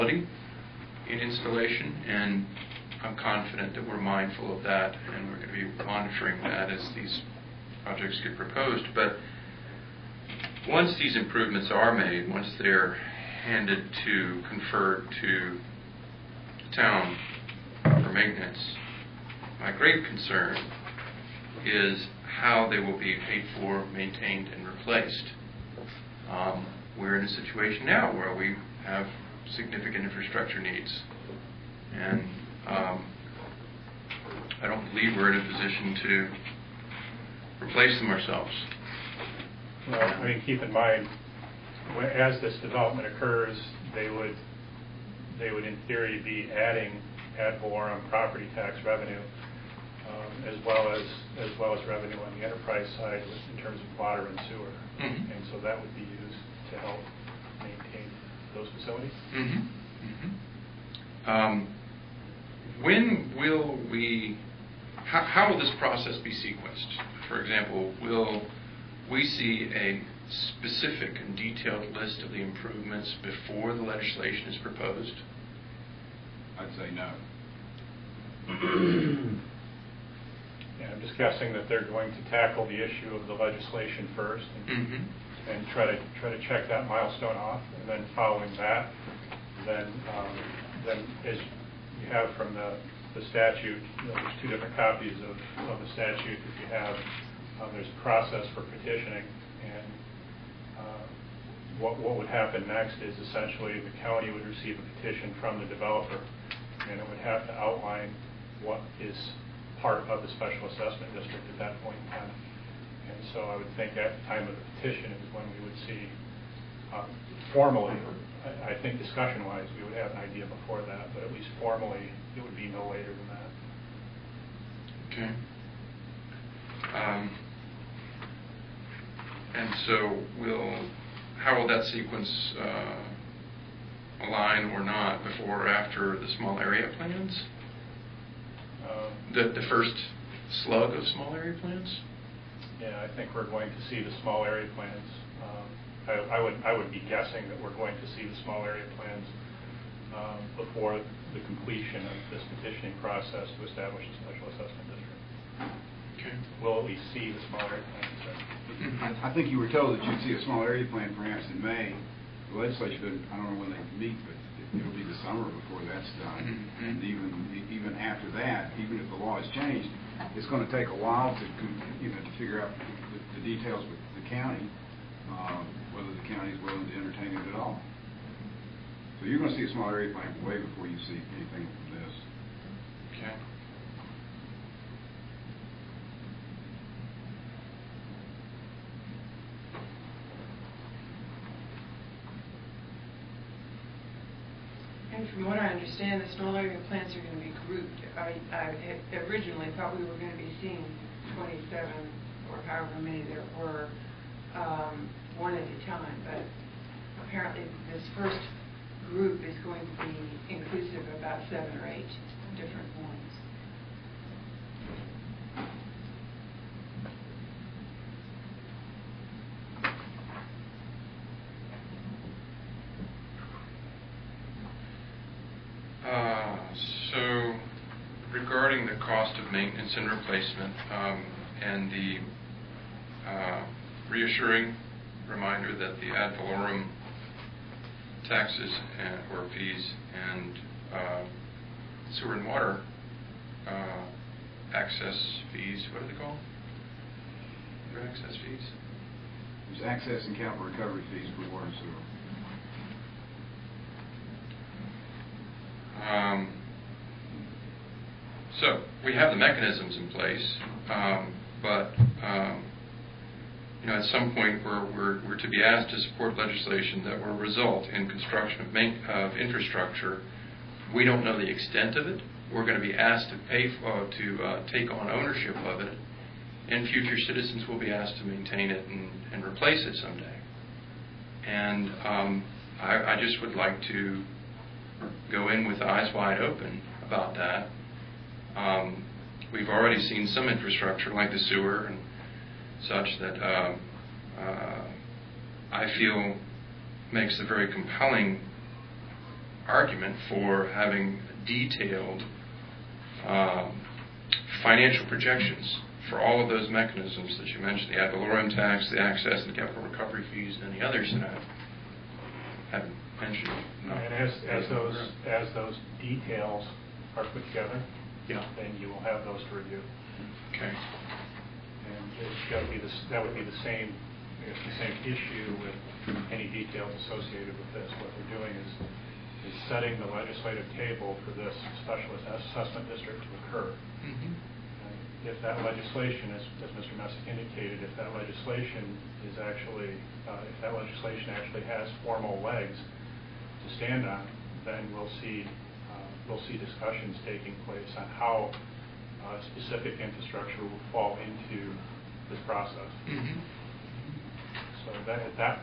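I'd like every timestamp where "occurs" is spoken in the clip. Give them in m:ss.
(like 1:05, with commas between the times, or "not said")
0:43, 5:33.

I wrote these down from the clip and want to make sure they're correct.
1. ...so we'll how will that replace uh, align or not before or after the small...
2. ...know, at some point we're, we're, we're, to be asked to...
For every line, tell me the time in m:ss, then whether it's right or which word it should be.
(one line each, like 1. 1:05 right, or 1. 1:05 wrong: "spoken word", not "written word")
1. 2:09 wrong: "sequence", not "replace"
2. 4:23 right.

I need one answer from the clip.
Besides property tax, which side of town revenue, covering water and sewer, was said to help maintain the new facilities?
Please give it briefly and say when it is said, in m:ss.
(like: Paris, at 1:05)
enterprise side, at 0:52.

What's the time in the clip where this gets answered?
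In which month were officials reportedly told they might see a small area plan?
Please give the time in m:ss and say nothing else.
2:41.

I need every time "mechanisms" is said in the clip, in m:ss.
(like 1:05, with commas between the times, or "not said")
4:19, 5:06.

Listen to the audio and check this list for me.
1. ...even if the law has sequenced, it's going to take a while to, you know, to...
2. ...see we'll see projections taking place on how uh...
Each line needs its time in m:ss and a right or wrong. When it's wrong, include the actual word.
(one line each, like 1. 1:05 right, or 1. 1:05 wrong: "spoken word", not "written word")
1. 2:48 wrong: "changed", not "sequenced"
2. 5:45 wrong: "discussions", not "projections".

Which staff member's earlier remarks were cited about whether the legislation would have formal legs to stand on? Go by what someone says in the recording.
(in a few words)
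Mr. Messick.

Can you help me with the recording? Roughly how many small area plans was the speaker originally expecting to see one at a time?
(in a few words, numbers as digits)
27.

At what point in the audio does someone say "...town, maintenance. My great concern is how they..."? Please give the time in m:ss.
0:16.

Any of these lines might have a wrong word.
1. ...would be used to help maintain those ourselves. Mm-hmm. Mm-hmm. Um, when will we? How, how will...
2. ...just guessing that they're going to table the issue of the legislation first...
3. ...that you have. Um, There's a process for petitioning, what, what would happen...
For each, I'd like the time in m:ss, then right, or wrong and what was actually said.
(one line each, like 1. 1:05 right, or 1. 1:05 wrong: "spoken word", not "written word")
1. 0:55 wrong: "facilities", not "ourselves"
2. 1:20 wrong: "tackle", not "table"
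3. 1:36 right.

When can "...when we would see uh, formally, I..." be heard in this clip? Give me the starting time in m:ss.
1:55.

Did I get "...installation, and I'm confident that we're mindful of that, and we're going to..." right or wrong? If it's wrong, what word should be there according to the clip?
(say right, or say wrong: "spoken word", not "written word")
right.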